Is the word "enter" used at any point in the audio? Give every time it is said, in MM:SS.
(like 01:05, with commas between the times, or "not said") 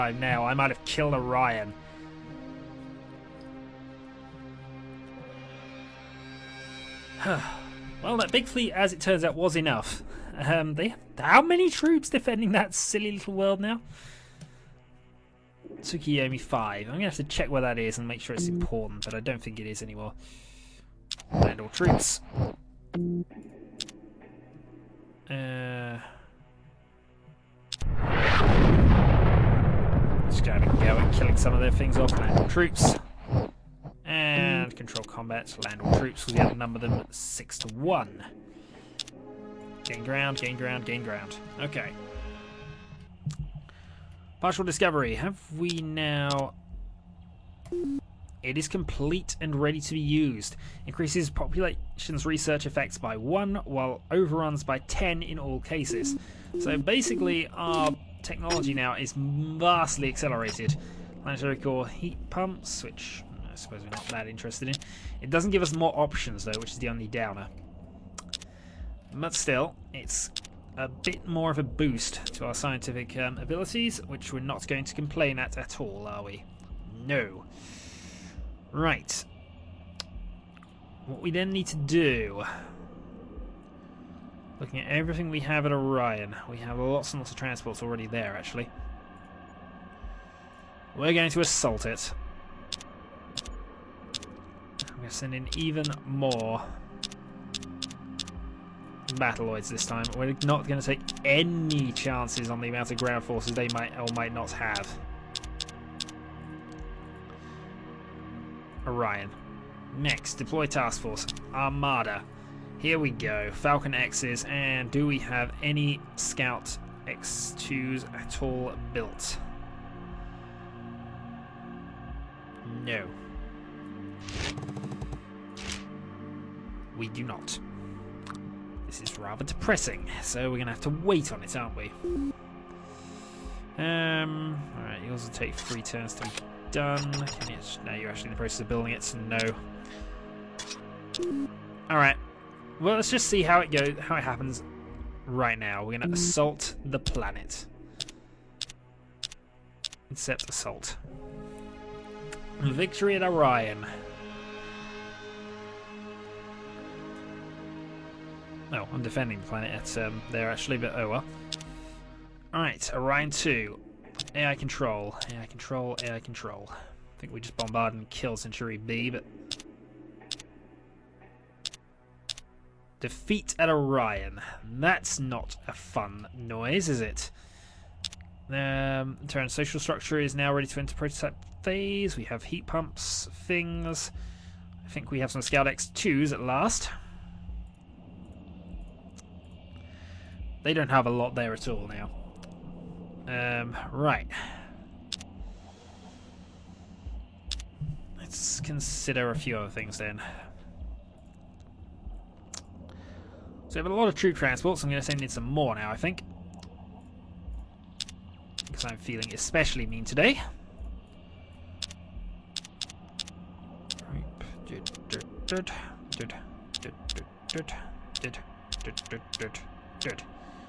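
03:00.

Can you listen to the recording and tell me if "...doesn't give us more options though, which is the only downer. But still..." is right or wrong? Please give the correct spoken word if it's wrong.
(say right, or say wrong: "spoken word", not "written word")
right.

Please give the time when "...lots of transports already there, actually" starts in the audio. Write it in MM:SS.
01:27.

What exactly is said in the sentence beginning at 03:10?
They don't have a lot there at all now.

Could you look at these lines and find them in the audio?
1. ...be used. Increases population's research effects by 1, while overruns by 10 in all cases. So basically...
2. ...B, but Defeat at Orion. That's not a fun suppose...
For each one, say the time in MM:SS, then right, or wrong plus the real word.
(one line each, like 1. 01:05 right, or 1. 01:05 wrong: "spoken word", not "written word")
1. 00:49 right
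2. 02:48 wrong: "noise", not "suppose".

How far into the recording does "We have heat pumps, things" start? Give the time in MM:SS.
03:02.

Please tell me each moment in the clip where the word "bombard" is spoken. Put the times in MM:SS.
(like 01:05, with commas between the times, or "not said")
02:47.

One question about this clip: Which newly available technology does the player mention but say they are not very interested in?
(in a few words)
Planetary core heat pumps.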